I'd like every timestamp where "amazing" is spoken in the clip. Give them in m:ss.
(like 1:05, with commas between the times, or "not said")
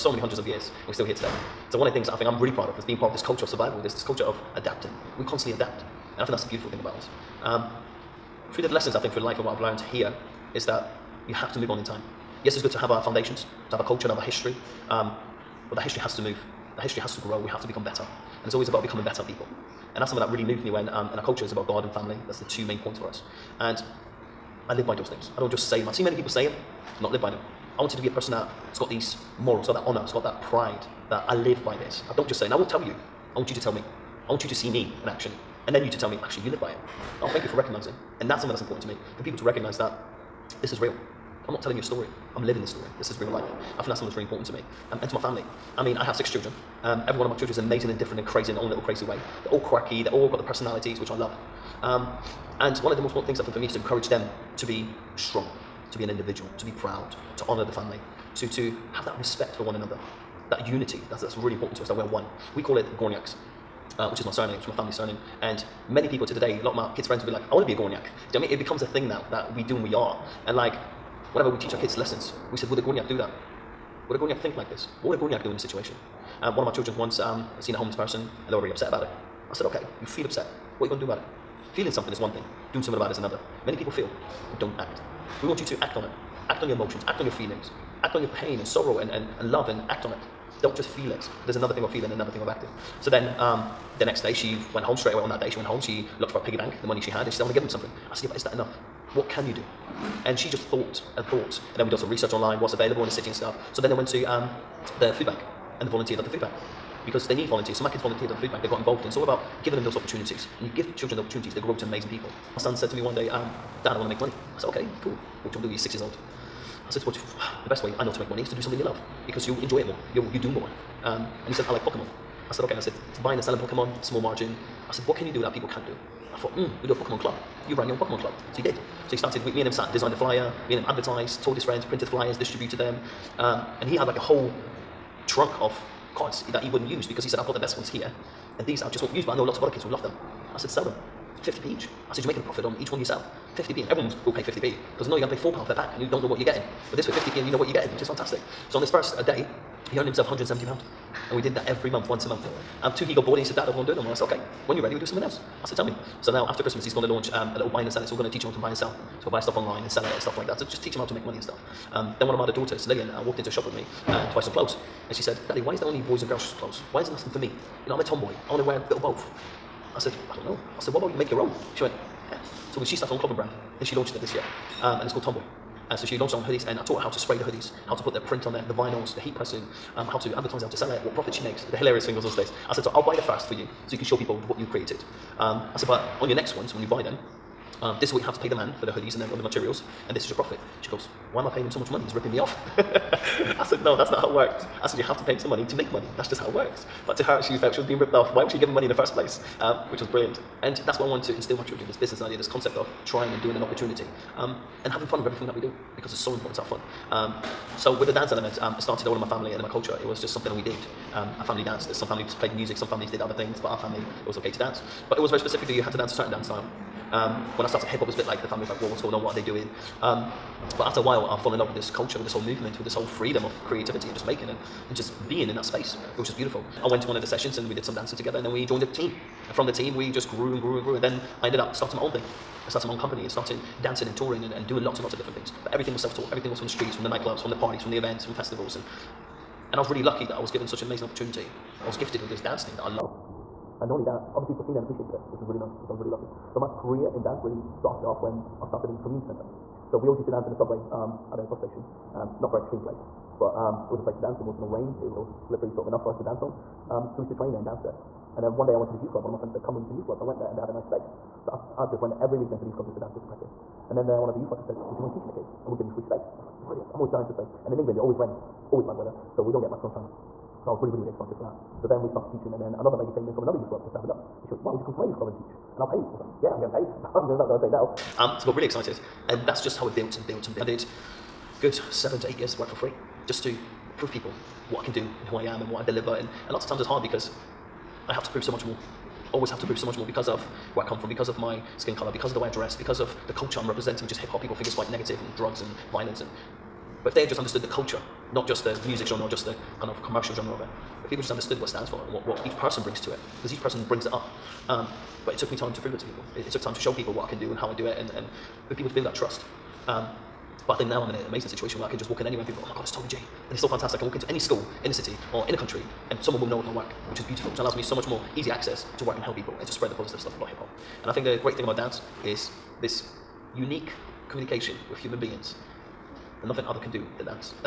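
0:47, 1:51, 4:00, 5:11.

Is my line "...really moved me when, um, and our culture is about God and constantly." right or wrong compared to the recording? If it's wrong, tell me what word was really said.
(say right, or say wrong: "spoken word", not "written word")
wrong: "family", not "constantly".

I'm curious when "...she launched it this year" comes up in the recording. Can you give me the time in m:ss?
2:53.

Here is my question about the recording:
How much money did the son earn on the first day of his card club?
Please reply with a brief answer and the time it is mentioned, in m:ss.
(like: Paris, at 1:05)
£170, at 2:30.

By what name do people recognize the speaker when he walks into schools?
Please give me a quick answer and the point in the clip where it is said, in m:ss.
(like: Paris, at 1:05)
Toby J, at 5:12.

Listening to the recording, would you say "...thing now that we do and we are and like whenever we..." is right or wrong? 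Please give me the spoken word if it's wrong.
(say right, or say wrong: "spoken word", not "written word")
right.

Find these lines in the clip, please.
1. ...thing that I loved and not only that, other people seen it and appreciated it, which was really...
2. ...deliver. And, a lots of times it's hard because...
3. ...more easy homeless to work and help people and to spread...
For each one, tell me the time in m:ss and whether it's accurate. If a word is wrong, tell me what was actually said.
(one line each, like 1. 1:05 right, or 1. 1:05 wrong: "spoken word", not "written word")
1. 4:02 right
2. 4:45 right
3. 5:18 wrong: "access", not "homeless".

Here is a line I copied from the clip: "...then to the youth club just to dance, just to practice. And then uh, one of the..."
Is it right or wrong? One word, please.
right.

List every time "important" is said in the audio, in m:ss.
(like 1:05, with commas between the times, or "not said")
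0:38, 0:44, 0:53, 1:01, 3:26.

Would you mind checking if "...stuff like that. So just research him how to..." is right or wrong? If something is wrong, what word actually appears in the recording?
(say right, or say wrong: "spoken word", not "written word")
wrong: "teach", not "research".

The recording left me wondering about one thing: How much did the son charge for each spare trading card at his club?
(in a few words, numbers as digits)
50p.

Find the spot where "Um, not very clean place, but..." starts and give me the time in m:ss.
4:12.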